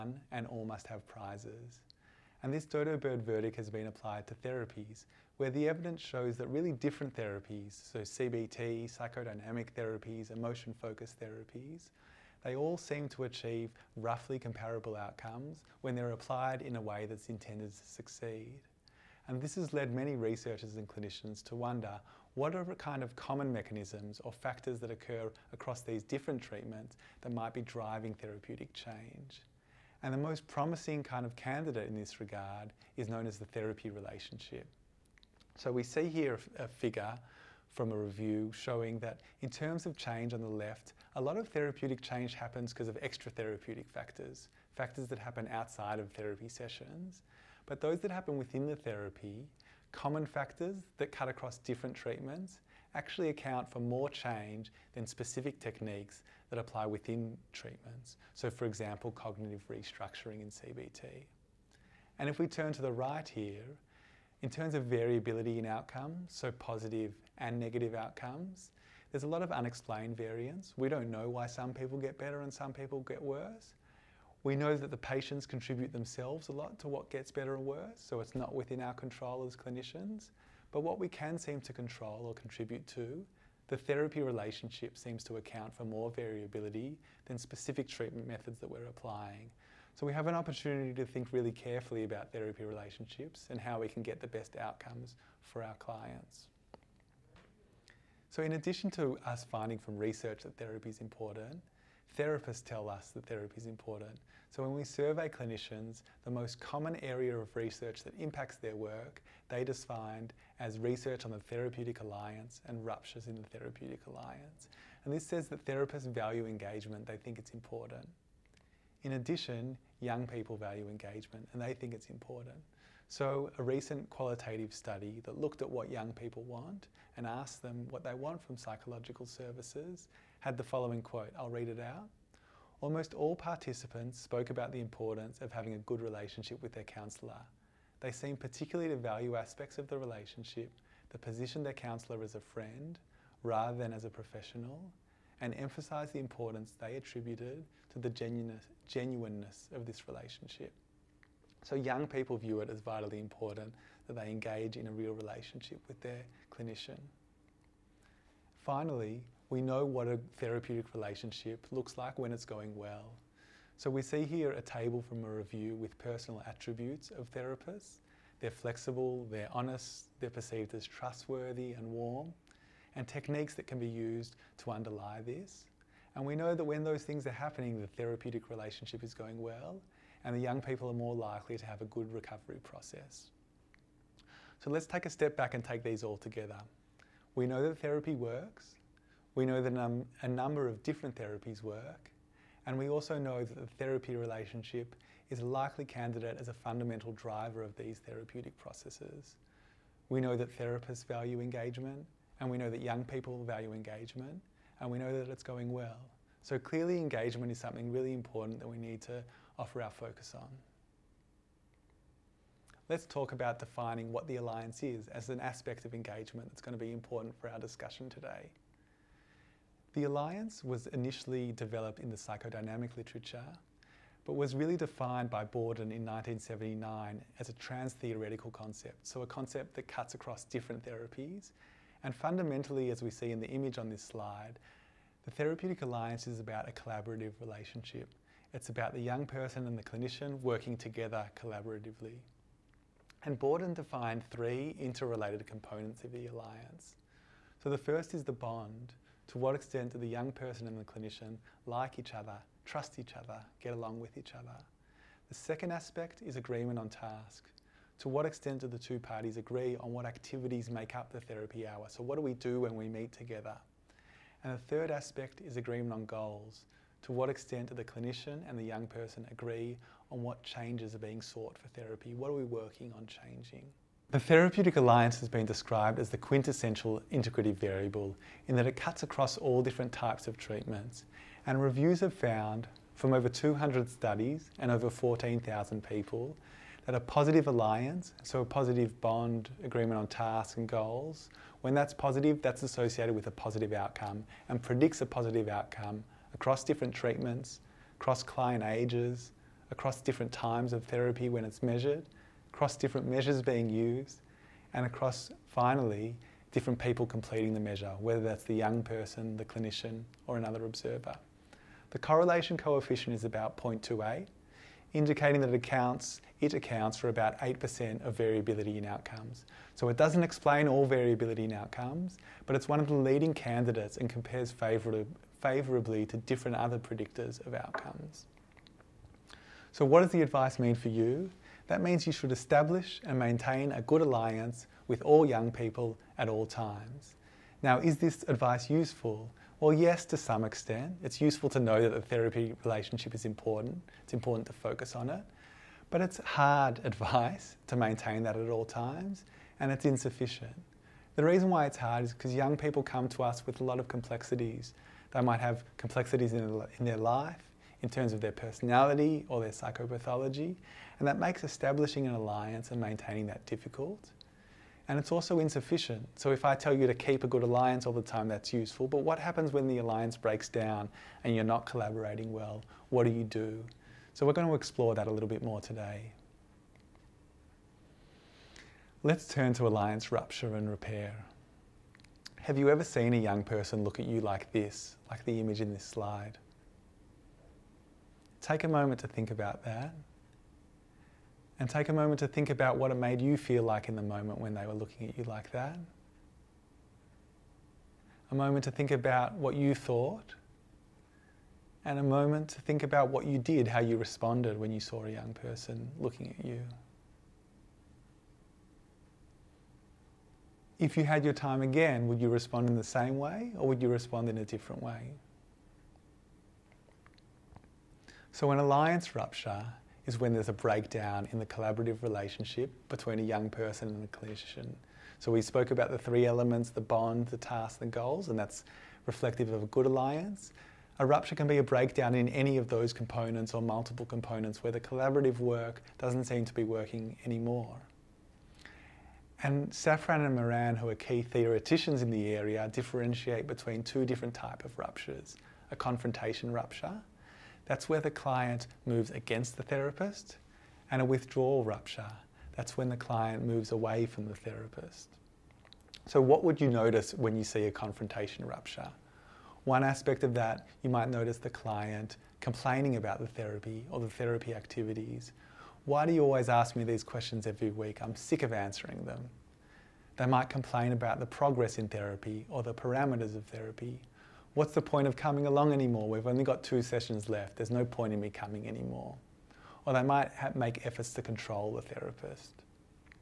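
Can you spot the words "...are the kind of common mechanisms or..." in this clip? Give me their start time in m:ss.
0:22.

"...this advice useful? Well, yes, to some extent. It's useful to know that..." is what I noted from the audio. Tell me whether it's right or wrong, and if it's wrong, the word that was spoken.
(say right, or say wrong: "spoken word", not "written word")
right.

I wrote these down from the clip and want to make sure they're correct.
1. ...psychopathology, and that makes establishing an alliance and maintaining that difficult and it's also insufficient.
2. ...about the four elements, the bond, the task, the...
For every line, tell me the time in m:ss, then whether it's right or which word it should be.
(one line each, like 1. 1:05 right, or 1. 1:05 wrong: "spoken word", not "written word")
1. 5:59 right
2. 7:05 wrong: "three", not "four".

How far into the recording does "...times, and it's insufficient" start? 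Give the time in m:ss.
5:48.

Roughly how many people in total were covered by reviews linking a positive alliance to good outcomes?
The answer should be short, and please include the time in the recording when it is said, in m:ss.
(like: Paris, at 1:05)
over 14,000, at 4:44.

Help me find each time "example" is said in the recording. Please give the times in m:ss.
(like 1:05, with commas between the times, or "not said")
0:58.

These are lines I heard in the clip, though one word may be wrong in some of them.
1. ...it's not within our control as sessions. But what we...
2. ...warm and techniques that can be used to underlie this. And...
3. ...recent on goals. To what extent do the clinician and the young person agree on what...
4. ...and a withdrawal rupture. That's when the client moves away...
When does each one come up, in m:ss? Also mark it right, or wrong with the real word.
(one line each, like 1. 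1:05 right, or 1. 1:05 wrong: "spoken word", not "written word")
1. 1:18 wrong: "clinicians", not "sessions"
2. 2:51 right
3. 4:25 wrong: "agreement", not "recent"
4. 7:30 right.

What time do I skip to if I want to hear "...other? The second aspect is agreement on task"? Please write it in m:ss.
4:14.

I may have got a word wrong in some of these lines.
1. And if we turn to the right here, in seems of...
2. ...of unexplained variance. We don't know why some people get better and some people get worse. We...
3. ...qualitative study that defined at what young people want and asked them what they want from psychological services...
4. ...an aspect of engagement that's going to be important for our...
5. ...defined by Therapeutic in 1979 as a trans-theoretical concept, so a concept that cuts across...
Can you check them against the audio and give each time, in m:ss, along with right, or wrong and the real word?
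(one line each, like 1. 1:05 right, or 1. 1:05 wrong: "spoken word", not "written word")
1. 1:02 wrong: "terms", not "seems"
2. 1:09 right
3. 2:04 wrong: "looked", not "defined"
4. 3:35 right
5. 3:44 wrong: "Bordin", not "Therapeutic".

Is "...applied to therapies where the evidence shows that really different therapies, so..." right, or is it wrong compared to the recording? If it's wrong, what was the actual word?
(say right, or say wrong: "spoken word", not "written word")
right.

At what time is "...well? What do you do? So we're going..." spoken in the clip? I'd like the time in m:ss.
6:12.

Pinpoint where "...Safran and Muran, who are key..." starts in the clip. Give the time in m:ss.
7:19.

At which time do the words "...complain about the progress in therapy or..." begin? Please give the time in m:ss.
7:50.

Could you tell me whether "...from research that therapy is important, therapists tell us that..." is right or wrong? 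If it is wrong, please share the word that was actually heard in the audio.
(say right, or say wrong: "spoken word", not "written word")
right.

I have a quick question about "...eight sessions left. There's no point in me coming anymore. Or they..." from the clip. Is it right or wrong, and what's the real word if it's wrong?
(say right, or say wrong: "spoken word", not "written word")
wrong: "two", not "eight".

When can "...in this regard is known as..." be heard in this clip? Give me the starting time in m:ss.
0:31.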